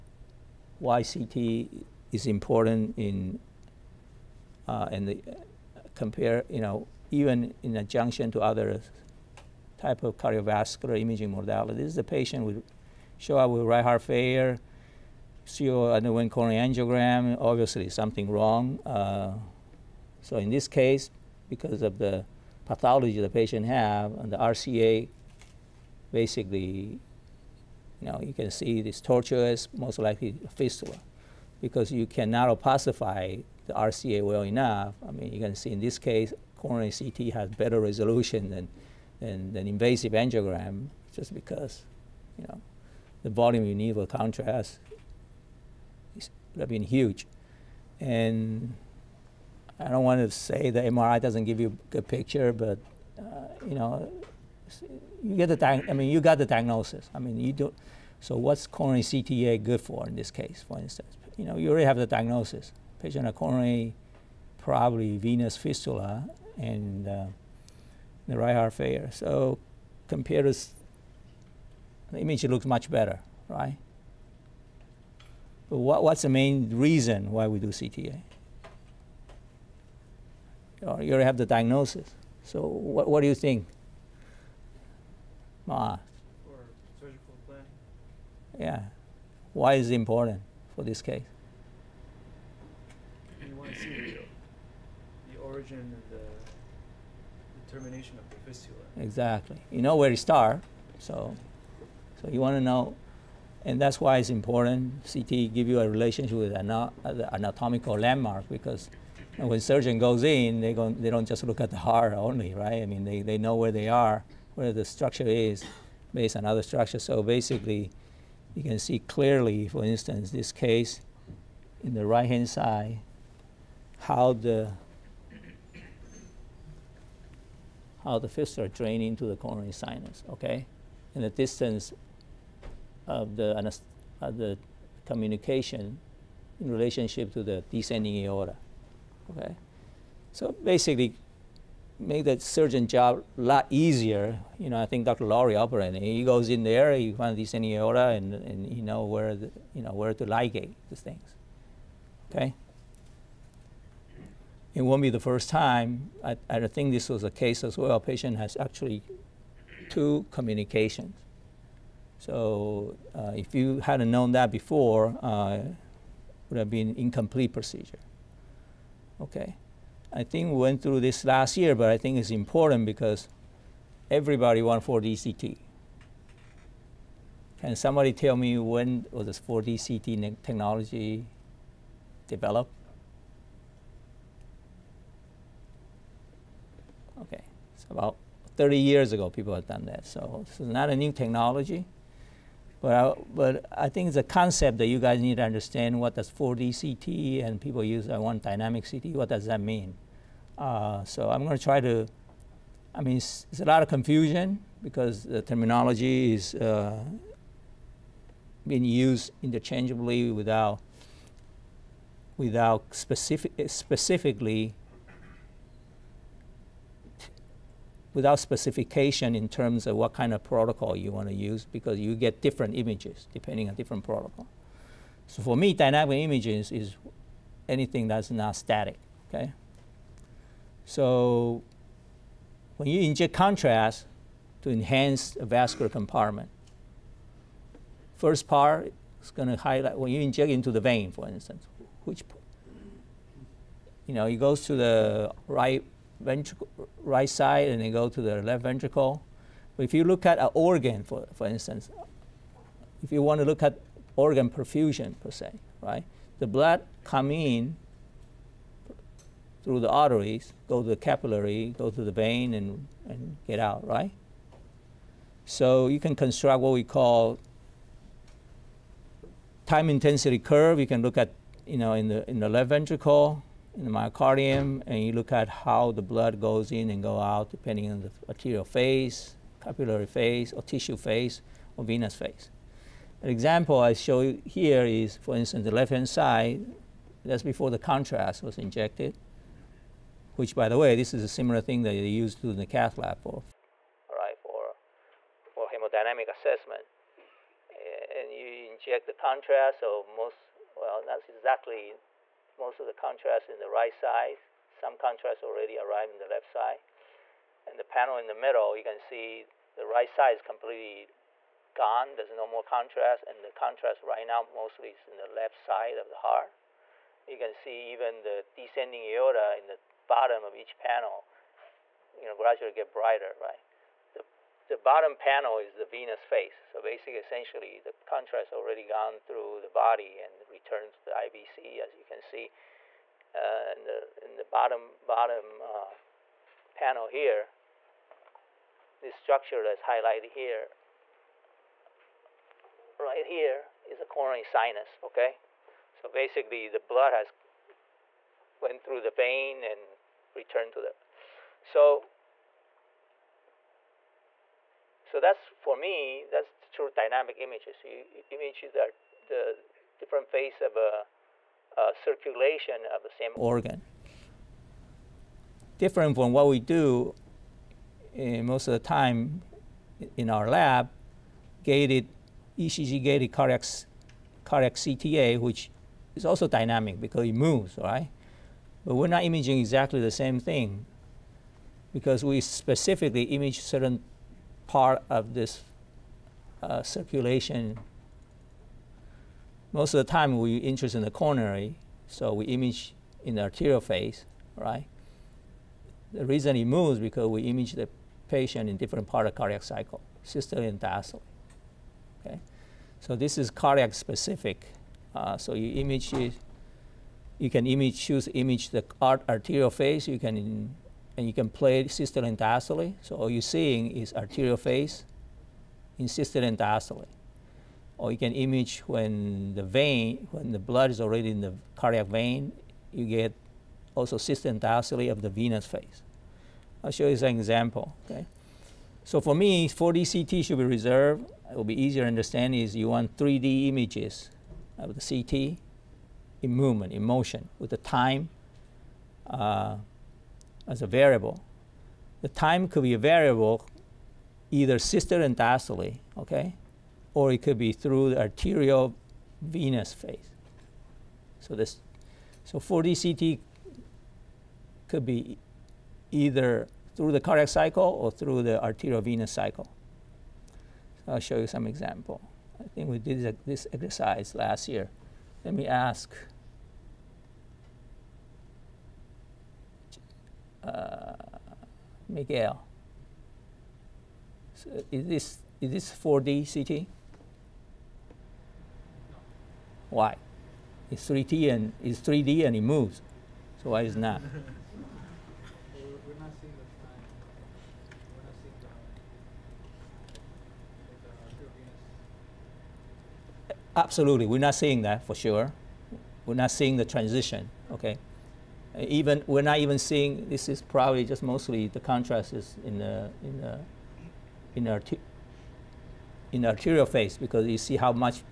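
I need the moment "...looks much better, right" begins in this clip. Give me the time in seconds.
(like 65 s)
72 s.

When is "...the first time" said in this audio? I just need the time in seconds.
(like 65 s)
155 s.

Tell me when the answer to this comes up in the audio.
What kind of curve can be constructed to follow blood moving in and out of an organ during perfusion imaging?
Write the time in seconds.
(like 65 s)
269 s.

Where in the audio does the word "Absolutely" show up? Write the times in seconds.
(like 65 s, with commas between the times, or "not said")
493 s.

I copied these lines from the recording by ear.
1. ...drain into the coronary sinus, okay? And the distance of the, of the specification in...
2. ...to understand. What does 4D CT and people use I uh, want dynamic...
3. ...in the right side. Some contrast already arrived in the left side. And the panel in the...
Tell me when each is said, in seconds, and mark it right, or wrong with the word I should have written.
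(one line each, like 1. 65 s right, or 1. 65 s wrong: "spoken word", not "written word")
1. 128 s wrong: "communication", not "specification"
2. 195 s right
3. 303 s right.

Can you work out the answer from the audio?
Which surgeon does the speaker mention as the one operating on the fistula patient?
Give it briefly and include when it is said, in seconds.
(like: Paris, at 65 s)
Dr. Laurie, at 145 s.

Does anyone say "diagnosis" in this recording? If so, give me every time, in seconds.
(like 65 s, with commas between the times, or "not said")
56 s, 62 s, 81 s.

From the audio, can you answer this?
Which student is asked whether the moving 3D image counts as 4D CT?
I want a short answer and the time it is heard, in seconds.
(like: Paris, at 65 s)
Miguel, at 472 s.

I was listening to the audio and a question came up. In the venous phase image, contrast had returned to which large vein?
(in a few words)
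IVC.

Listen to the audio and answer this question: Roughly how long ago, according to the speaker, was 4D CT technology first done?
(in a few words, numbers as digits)
30 years ago.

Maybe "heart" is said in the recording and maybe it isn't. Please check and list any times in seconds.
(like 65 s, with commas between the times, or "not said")
13 s, 68 s, 111 s, 316 s.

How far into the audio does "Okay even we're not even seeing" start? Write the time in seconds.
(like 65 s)
497 s.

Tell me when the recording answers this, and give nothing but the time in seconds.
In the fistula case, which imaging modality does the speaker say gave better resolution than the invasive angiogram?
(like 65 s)
36 s.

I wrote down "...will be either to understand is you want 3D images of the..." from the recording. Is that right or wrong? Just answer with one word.
wrong.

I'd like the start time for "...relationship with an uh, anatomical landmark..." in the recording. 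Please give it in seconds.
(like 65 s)
105 s.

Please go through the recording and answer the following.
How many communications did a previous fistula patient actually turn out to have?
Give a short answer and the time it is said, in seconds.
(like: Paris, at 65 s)
2, at 159 s.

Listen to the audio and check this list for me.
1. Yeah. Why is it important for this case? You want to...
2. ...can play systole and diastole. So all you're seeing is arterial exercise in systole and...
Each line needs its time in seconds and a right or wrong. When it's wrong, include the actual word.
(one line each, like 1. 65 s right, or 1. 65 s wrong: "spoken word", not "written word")
1. 88 s right
2. 411 s wrong: "phase", not "exercise".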